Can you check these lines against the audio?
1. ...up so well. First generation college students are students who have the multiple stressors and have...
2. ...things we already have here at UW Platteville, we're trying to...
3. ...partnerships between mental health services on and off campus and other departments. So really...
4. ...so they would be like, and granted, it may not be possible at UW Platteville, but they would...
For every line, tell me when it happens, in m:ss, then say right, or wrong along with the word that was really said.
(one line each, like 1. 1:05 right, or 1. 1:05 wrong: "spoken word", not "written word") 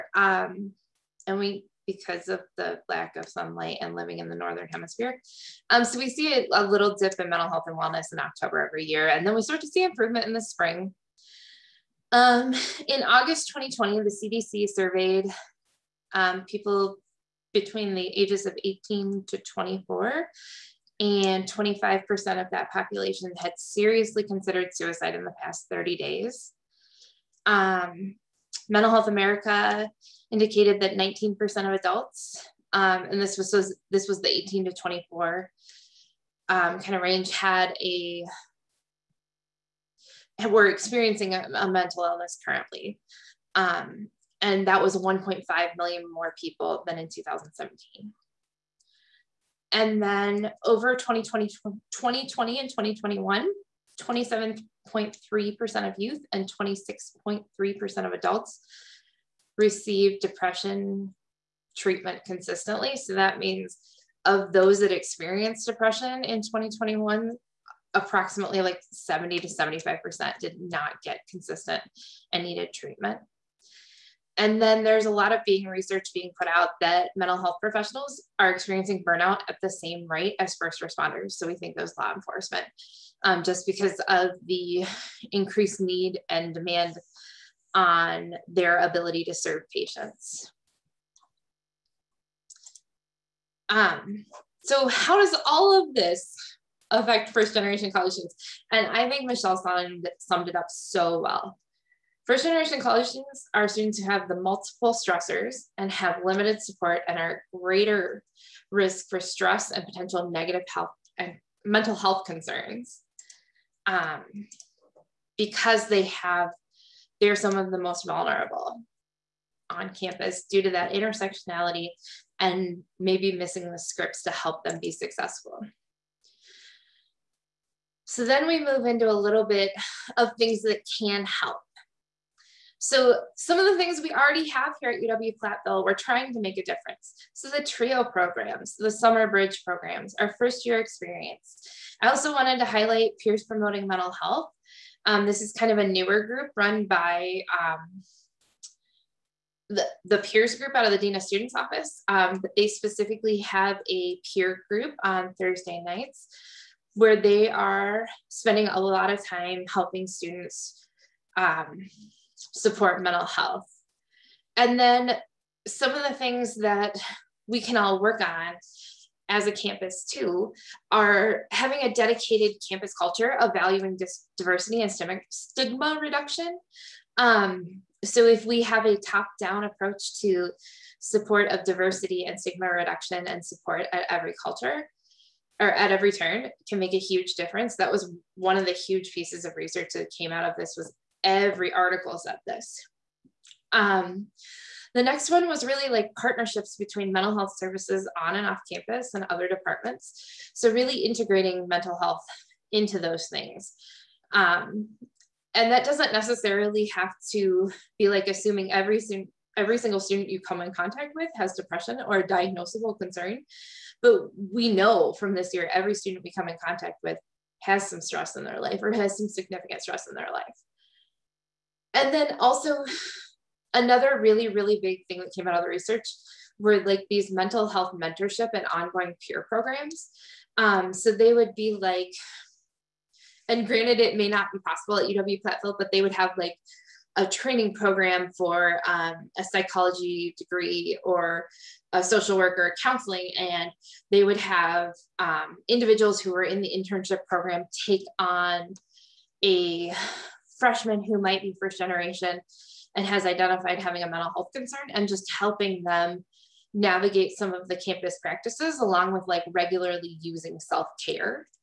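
1. 1:40 right
2. 2:13 right
3. 3:16 right
4. 3:50 right.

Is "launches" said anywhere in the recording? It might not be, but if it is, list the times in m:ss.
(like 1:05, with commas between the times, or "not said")
not said.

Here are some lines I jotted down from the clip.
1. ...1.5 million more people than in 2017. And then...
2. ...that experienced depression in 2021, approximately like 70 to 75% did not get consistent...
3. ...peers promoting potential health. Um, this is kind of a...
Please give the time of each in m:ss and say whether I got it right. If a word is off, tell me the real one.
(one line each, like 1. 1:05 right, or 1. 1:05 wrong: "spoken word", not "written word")
1. 0:44 right
2. 1:04 right
3. 2:23 wrong: "mental", not "potential".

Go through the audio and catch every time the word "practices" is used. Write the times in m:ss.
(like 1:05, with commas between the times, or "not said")
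4:18.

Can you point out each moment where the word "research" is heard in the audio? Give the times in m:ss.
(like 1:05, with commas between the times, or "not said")
1:15, 3:09, 3:45.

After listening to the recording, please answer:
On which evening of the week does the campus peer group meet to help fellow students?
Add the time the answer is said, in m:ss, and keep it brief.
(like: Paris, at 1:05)
Thursday nights, at 2:35.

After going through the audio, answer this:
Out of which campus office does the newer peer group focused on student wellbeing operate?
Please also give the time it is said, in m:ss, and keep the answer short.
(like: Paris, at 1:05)
Dean of Students office, at 2:30.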